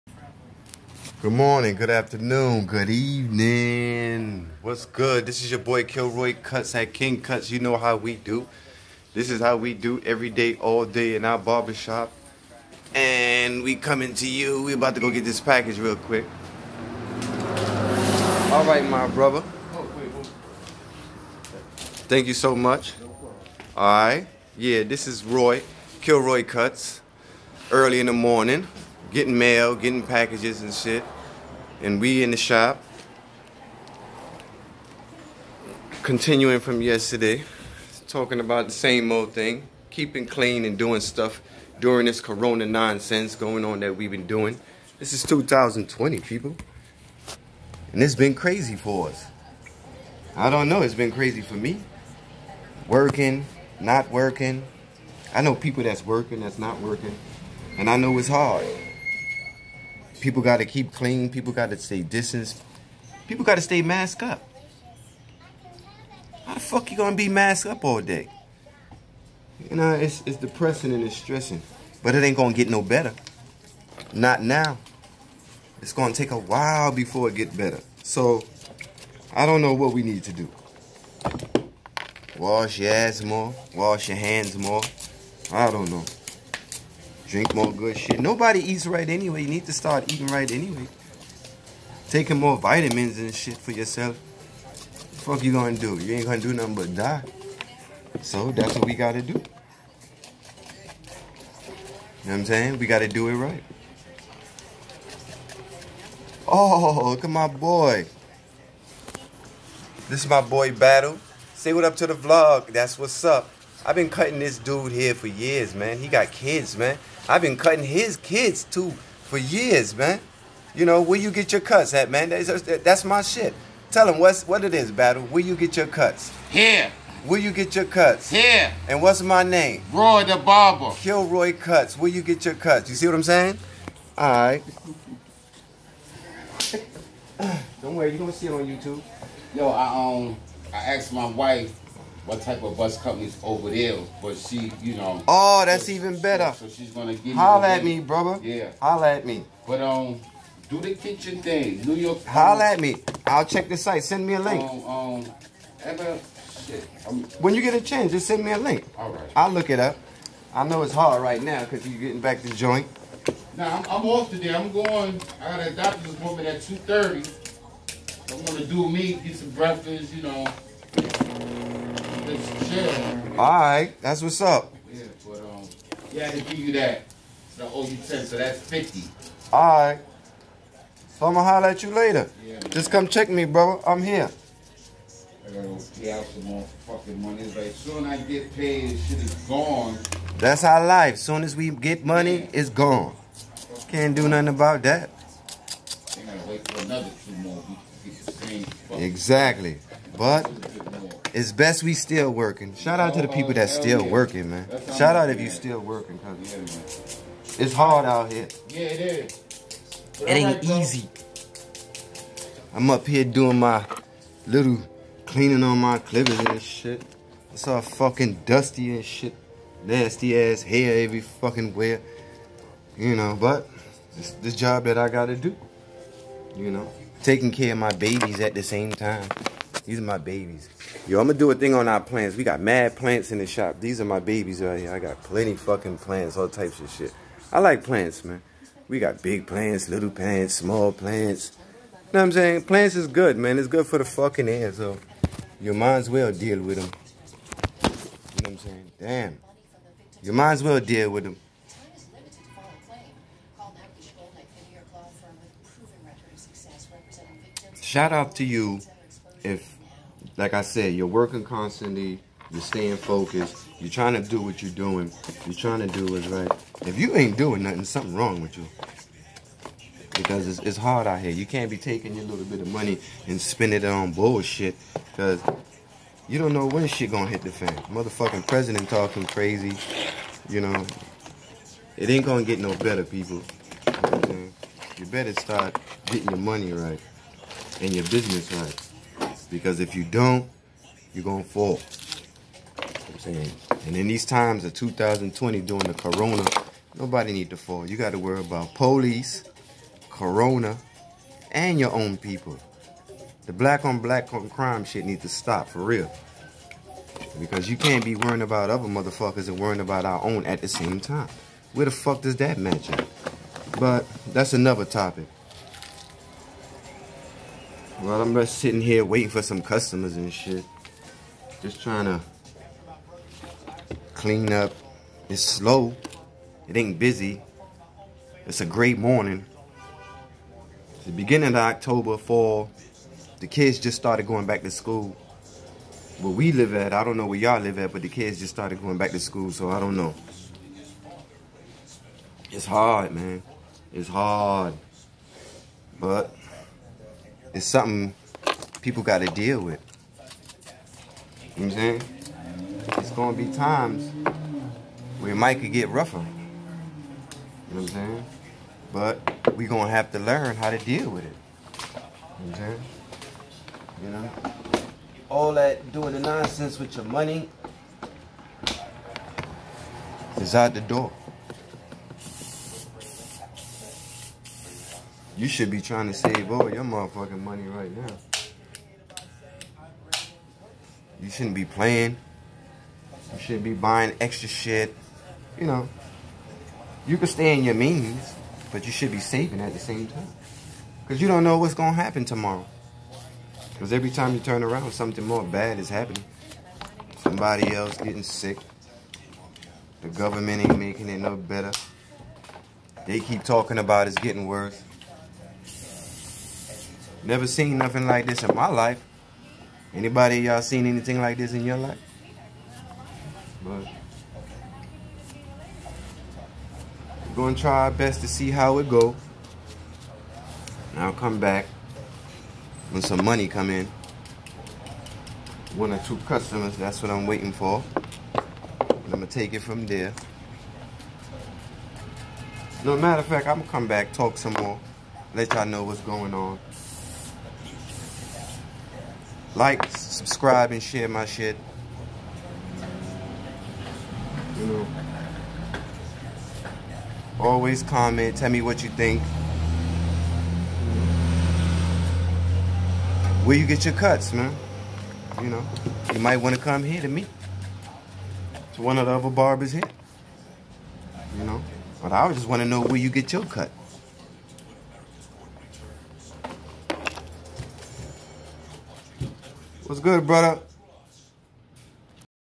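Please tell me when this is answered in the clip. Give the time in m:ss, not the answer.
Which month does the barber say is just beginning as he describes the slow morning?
5:31.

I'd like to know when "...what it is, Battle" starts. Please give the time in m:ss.
2:04.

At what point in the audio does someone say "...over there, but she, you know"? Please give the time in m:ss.
2:23.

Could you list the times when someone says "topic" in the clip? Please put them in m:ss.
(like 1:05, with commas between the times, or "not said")
5:14.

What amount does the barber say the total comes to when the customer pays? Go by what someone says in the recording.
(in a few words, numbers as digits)
50.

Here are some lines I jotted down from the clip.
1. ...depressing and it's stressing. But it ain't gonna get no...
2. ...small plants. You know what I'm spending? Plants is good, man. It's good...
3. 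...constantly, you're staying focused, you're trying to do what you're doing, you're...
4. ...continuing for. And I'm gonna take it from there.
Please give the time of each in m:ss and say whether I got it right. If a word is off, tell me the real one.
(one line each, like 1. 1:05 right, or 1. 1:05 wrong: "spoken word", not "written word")
1. 1:10 right
2. 4:00 wrong: "saying", not "spending"
3. 4:21 right
4. 7:07 wrong: "waiting", not "continuing".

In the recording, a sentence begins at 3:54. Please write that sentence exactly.
I got plenty fucking plants, all types of shit.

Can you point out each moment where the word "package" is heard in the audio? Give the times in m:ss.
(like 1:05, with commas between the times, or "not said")
0:15, 0:30.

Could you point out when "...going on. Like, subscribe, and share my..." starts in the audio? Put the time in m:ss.
7:16.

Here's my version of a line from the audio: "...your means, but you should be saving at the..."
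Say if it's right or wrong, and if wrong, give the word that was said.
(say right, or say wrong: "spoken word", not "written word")
right.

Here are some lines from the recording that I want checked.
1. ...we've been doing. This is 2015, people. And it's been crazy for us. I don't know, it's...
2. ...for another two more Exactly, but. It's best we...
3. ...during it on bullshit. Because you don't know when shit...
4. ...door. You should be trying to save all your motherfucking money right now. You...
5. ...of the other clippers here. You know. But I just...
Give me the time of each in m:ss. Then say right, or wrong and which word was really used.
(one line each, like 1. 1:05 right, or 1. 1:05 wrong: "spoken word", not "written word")
1. 0:43 wrong: "2020", not "2015"
2. 3:16 right
3. 4:33 wrong: "spending", not "during"
4. 6:10 right
5. 7:38 wrong: "barbers", not "clippers".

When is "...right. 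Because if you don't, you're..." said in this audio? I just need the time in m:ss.
4:48.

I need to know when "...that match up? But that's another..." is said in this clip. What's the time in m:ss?
5:12.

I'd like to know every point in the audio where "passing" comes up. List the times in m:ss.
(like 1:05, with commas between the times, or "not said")
not said.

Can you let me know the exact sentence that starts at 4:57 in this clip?
You got to worry about police, corona, and your own people.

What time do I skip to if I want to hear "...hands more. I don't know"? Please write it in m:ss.
1:24.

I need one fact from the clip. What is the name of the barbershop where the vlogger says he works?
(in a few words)
King Cuts.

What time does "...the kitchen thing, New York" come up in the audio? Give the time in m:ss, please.
2:30.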